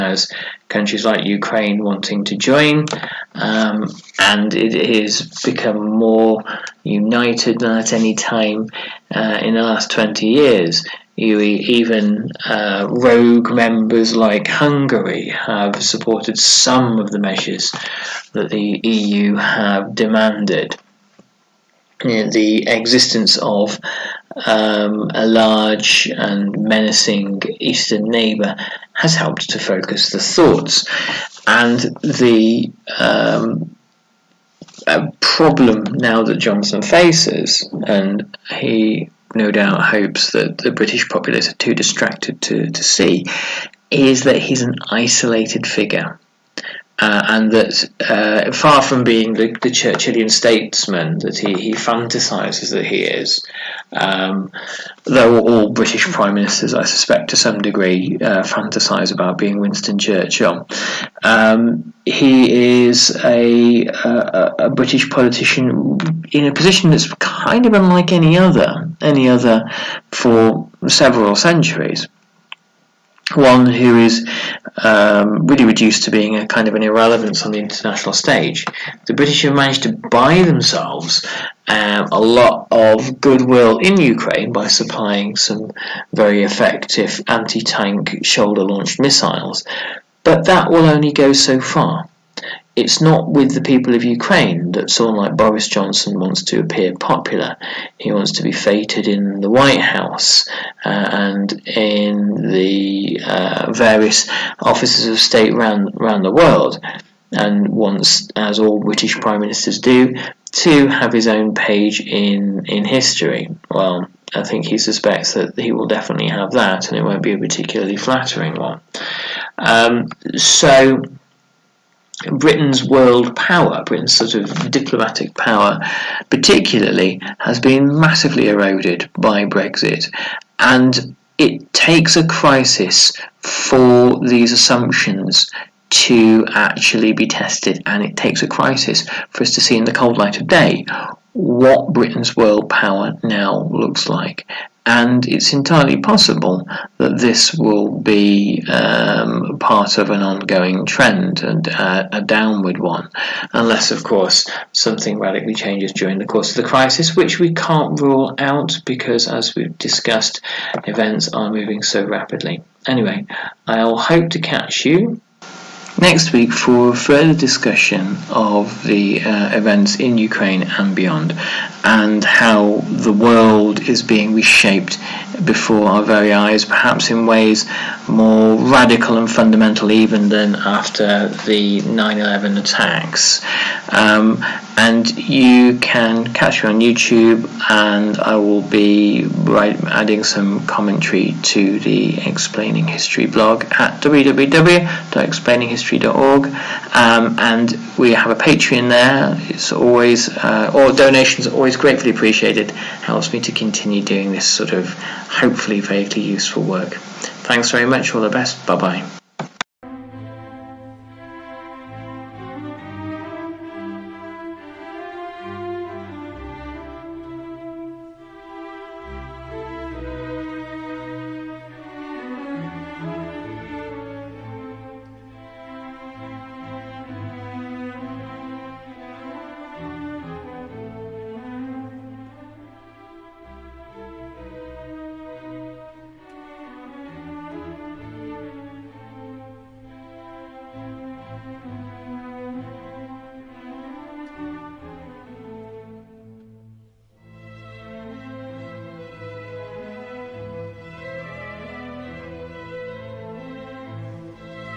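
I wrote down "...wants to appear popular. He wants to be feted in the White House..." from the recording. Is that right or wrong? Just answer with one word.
right.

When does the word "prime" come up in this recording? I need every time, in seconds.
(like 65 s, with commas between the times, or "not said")
56 s, 109 s.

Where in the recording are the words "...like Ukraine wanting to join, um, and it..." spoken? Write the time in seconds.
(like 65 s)
1 s.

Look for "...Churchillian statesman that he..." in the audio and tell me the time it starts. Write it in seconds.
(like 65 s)
49 s.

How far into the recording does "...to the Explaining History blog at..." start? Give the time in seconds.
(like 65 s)
191 s.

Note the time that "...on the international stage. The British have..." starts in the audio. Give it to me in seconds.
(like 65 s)
77 s.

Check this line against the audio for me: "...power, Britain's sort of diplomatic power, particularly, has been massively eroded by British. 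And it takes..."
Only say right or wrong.
wrong.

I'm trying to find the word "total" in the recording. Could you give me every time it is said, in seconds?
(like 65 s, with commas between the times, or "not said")
not said.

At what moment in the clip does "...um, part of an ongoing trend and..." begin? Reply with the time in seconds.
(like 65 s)
148 s.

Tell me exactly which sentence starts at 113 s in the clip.
Well, I think he suspects that he will definitely have that, and it won't be a particularly flattering one.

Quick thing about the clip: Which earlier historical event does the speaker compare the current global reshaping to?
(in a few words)
The 9/11 attacks.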